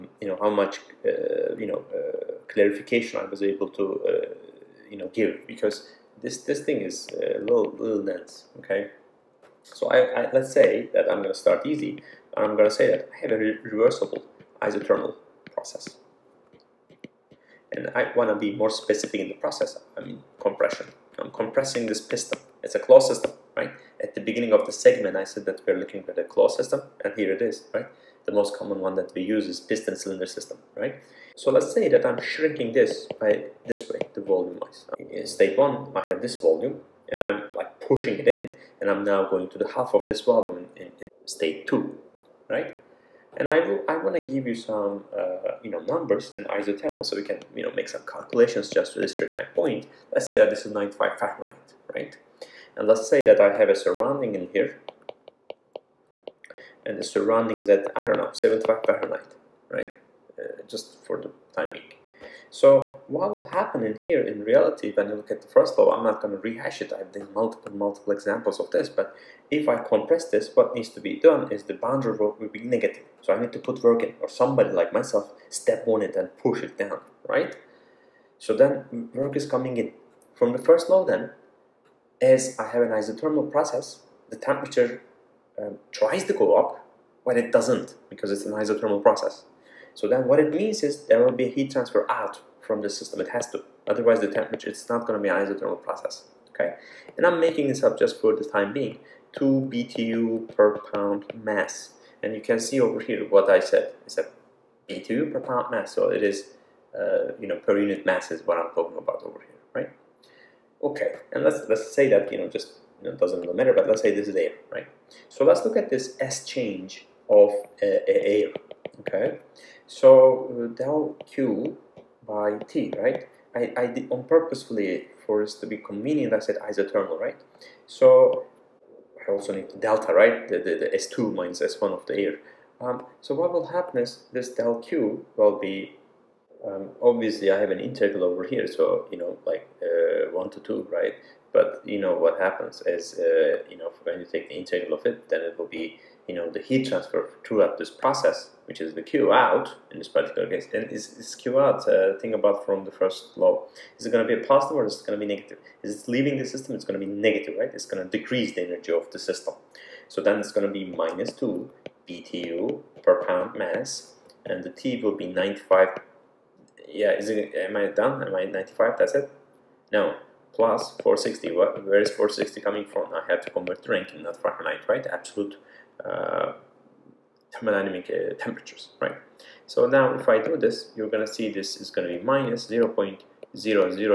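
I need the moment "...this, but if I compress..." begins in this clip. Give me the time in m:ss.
1:08.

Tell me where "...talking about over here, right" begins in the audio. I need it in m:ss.
1:48.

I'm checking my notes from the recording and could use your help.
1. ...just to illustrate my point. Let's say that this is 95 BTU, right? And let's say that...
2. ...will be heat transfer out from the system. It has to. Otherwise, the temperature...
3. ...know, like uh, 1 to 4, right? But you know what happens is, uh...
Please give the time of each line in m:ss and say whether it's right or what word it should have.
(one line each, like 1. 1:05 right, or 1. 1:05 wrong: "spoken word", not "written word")
1. 0:48 wrong: "Fahrenheit", not "BTU"
2. 1:31 right
3. 2:19 wrong: "2", not "4".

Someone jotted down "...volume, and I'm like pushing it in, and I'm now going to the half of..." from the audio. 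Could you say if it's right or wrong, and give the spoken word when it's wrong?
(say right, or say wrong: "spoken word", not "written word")
right.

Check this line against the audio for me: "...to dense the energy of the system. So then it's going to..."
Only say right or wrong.
wrong.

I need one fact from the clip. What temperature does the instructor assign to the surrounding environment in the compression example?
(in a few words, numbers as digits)
75 Fahrenheit.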